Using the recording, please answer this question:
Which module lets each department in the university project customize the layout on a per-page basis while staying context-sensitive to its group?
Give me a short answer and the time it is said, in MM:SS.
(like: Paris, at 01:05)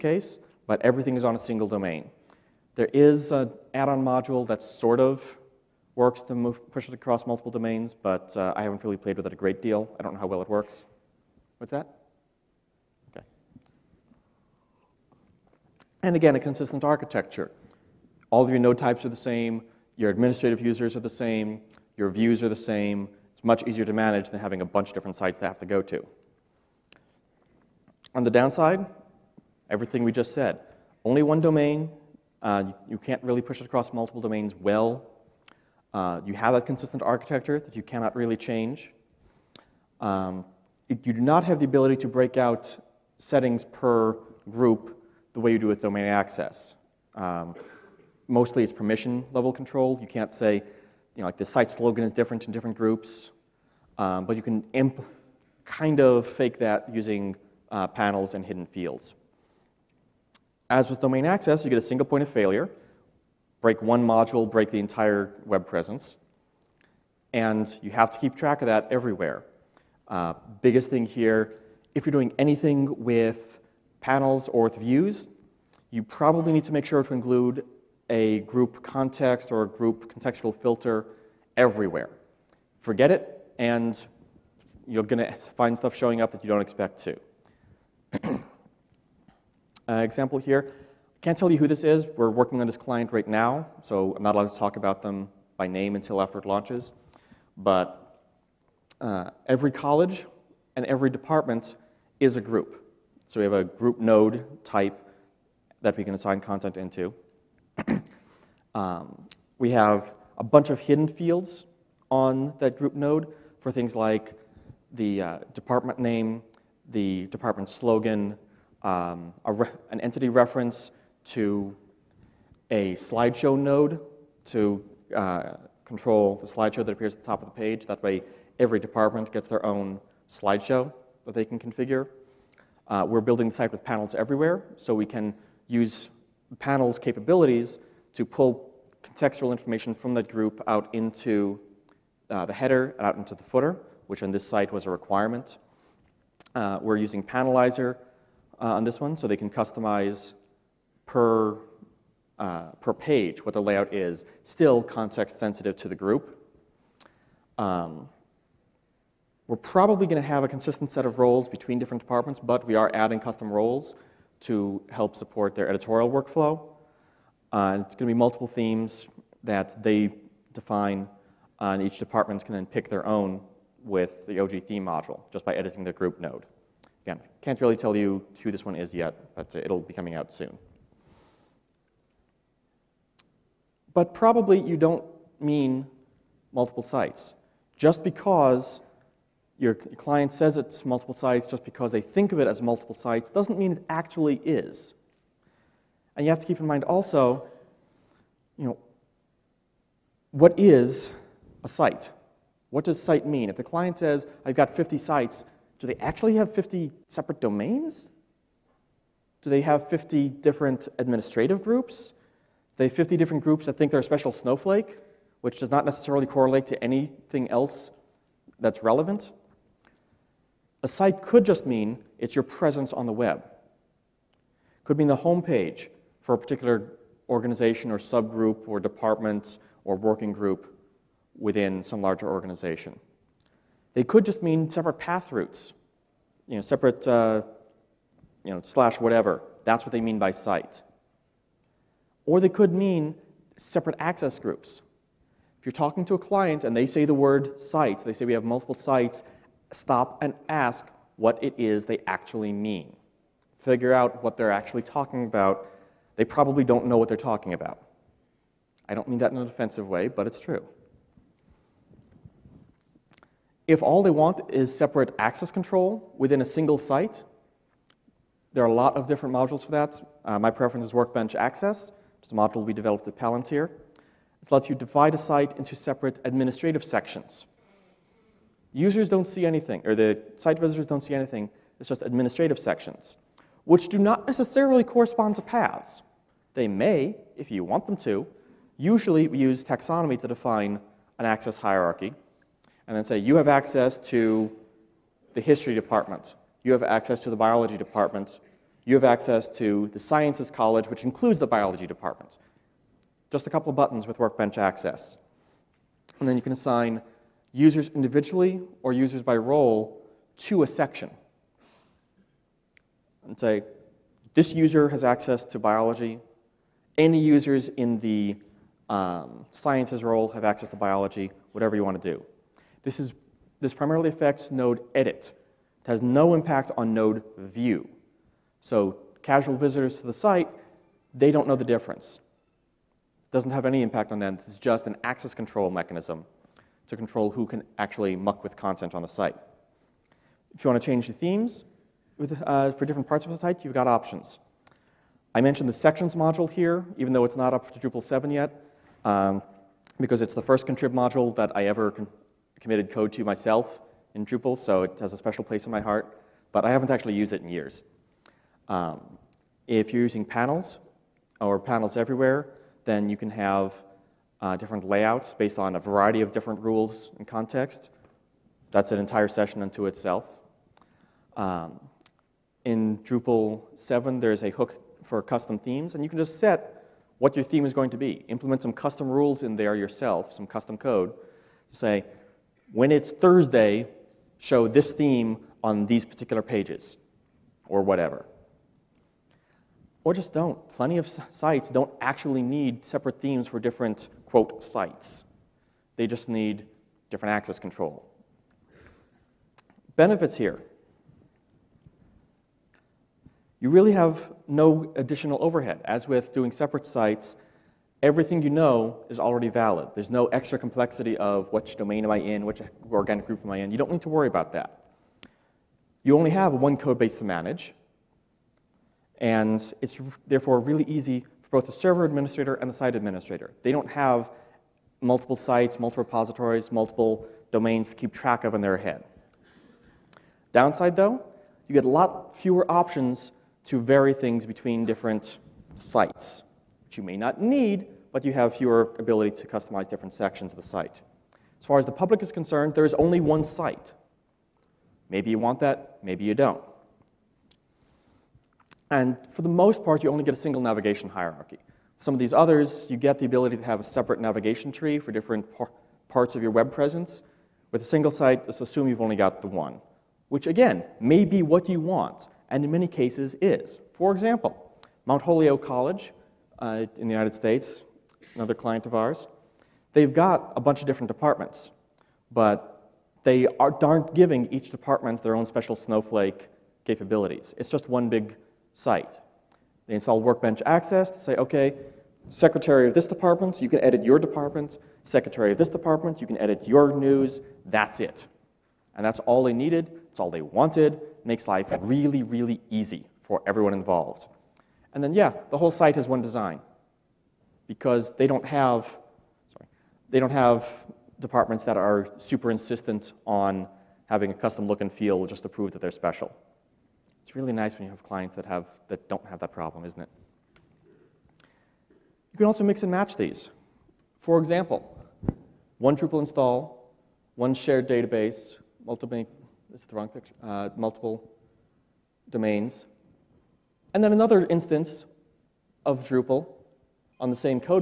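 Panelizer, at 02:27.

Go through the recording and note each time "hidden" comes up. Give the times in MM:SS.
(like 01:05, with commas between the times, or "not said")
00:58, 01:50.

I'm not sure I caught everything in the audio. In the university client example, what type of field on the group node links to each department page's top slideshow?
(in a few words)
entity reference.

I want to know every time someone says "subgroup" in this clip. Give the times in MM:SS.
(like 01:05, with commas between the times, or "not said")
03:47.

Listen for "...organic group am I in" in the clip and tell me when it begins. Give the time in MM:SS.
06:52.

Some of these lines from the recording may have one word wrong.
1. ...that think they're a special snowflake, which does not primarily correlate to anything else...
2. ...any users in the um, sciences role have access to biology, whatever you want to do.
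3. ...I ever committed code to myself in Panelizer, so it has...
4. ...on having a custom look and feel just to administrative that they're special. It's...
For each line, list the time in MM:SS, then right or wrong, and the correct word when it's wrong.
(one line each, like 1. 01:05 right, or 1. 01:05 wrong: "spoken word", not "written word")
1. 03:33 wrong: "necessarily", not "primarily"
2. 05:16 right
3. 05:51 wrong: "Drupal", not "Panelizer"
4. 08:23 wrong: "prove", not "administrative".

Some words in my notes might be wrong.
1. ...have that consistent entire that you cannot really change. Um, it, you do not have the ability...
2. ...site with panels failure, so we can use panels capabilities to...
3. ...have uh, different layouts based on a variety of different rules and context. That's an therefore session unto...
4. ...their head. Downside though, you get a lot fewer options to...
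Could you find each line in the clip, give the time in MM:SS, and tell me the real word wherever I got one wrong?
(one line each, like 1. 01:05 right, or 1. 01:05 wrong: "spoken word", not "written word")
1. 00:36 wrong: "architecture", not "entire"
2. 02:13 wrong: "everywhere", not "failure"
3. 06:03 wrong: "entire", not "therefore"
4. 07:08 right.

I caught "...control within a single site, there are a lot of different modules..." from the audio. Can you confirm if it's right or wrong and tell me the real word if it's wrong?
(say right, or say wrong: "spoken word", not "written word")
right.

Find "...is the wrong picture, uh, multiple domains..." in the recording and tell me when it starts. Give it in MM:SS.
08:39.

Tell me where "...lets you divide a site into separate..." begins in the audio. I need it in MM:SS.
04:34.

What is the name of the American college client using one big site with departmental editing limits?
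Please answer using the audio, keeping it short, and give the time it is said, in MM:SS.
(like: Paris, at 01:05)
Mount Holyoke College, at 07:45.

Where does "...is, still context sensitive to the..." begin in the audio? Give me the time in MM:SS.
02:33.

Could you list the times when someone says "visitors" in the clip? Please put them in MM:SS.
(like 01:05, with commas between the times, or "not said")
04:40, 05:29.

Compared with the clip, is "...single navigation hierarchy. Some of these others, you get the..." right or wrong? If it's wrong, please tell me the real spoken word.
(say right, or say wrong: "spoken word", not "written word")
right.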